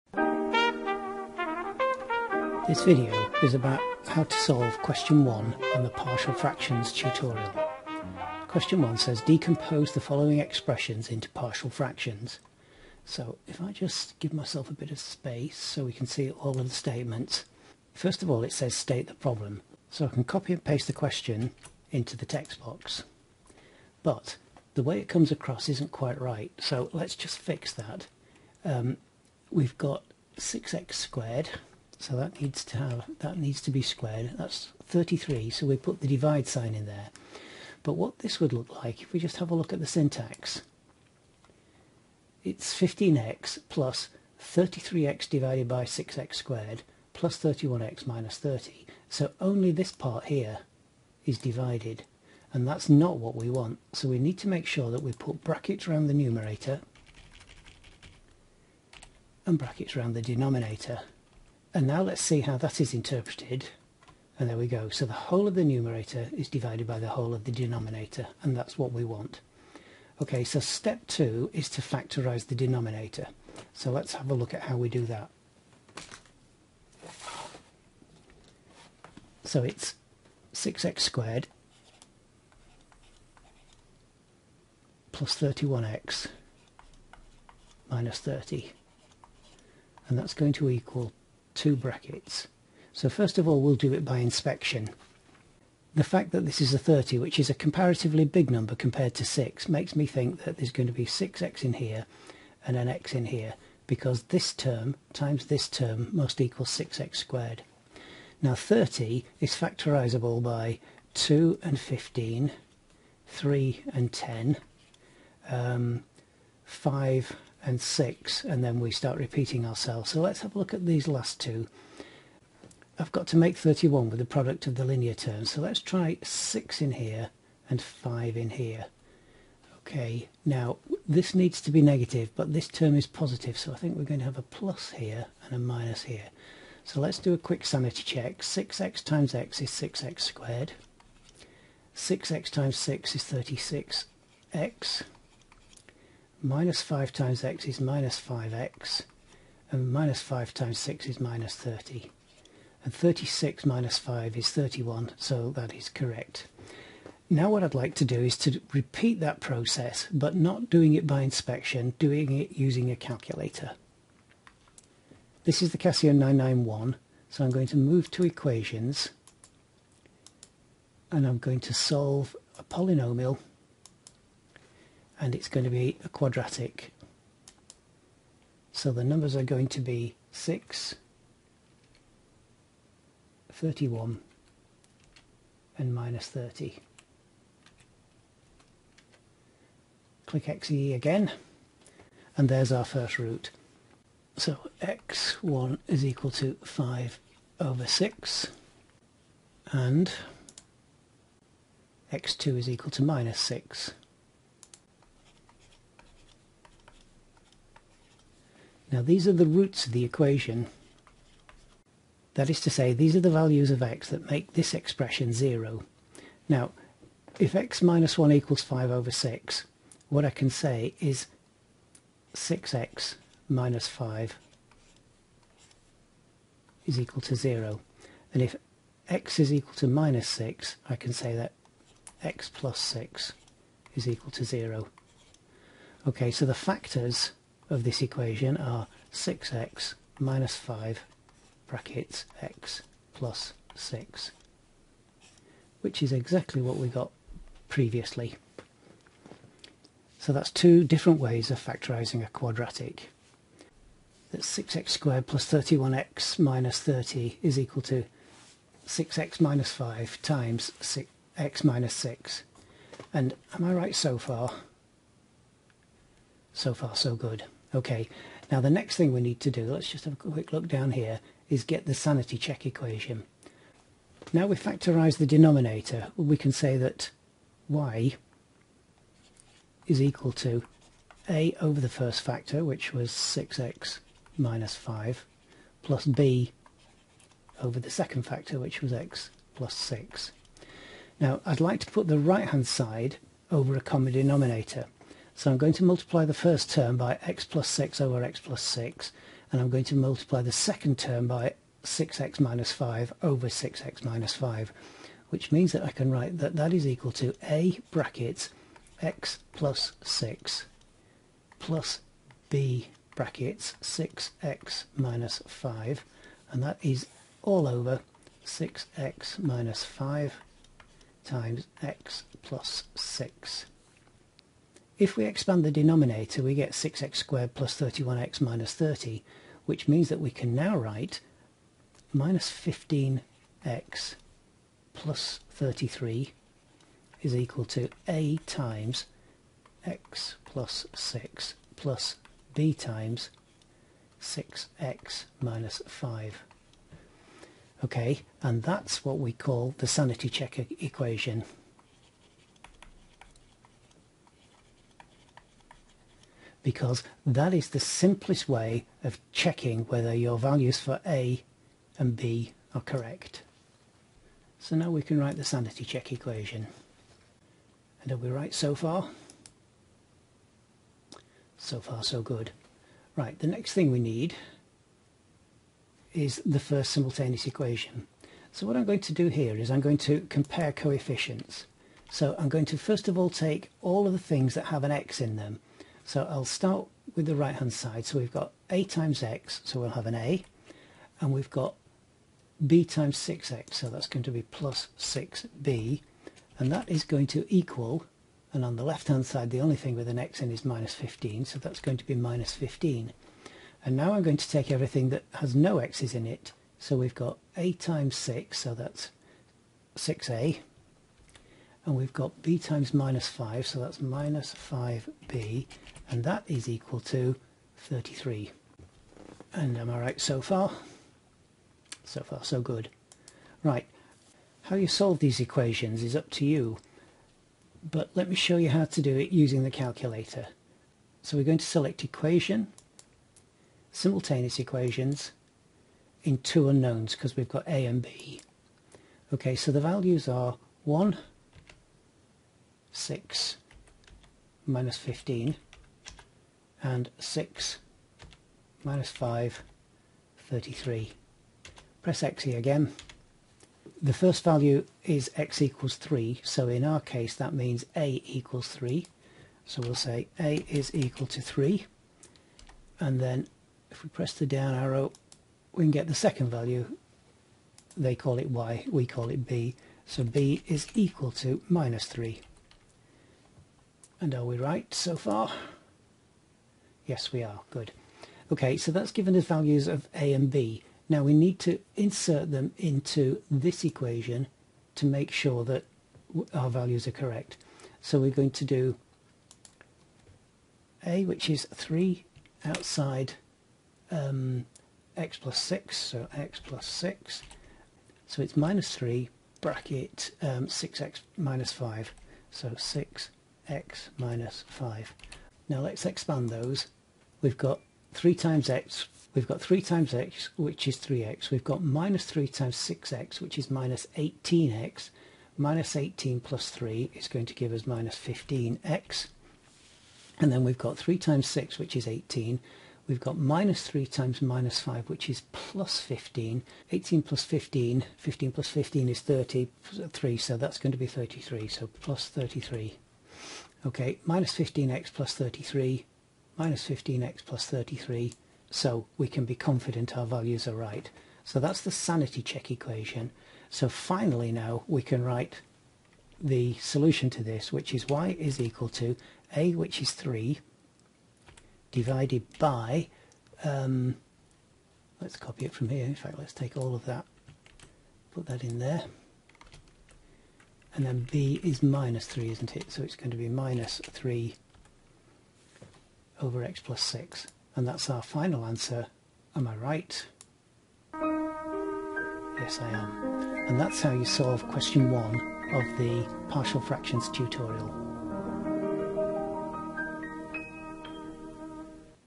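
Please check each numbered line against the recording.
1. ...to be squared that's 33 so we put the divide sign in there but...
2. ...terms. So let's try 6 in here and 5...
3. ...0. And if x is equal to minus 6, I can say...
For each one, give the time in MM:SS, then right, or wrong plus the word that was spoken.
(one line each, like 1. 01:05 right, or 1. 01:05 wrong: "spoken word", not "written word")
1. 00:33 right
2. 02:05 right
3. 03:47 right.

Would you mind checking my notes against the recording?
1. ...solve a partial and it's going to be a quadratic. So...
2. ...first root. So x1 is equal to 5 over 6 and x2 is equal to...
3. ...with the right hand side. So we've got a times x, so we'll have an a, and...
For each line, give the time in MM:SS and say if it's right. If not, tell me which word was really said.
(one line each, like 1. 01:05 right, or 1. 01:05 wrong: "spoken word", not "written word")
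1. 02:51 wrong: "polynomial", not "partial"
2. 03:12 right
3. 06:27 right.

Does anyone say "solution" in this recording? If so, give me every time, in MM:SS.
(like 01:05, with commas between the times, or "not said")
09:06.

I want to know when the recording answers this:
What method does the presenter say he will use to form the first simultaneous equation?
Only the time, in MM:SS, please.
06:20.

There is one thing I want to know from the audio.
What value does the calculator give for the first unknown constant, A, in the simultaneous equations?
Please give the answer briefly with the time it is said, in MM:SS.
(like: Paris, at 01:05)
3, at 07:37.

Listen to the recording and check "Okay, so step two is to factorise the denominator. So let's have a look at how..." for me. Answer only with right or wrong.
right.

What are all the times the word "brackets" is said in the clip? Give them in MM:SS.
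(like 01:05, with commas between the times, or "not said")
00:55, 00:59, 01:31, 04:01, 05:07, 05:13, 08:19.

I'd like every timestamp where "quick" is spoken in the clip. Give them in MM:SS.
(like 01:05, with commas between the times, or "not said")
02:17, 04:30.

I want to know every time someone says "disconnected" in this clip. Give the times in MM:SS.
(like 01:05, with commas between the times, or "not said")
not said.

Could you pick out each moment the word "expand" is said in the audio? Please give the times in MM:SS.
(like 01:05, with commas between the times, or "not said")
05:25, 08:26.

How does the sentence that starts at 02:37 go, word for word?
Now what I'd like to do is to repeat that process, but not doing it by inspection, doing it using a calculator.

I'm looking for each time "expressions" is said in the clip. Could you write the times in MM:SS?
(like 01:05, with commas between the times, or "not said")
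00:10, 03:34.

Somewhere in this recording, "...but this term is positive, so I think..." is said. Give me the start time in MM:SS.
02:12.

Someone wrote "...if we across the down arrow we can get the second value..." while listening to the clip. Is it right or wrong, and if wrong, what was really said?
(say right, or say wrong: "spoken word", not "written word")
wrong: "press", not "across".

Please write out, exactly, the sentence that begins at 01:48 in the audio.
Now 30 is factorisable by 2 and 15, 3 and 10, um, 5 and 6 and then we start repeating ourselves.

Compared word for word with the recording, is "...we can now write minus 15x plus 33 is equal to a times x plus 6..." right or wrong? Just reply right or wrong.
right.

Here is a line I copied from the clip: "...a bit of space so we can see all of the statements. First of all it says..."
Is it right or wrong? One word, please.
right.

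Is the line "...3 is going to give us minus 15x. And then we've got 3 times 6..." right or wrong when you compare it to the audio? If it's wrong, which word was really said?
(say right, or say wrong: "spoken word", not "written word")
right.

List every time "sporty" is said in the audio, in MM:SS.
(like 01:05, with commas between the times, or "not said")
not said.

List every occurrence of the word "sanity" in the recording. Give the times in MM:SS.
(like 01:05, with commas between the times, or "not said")
02:17, 04:31, 05:49, 06:05, 09:01.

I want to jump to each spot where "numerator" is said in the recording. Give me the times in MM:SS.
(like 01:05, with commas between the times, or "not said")
00:56, 01:05.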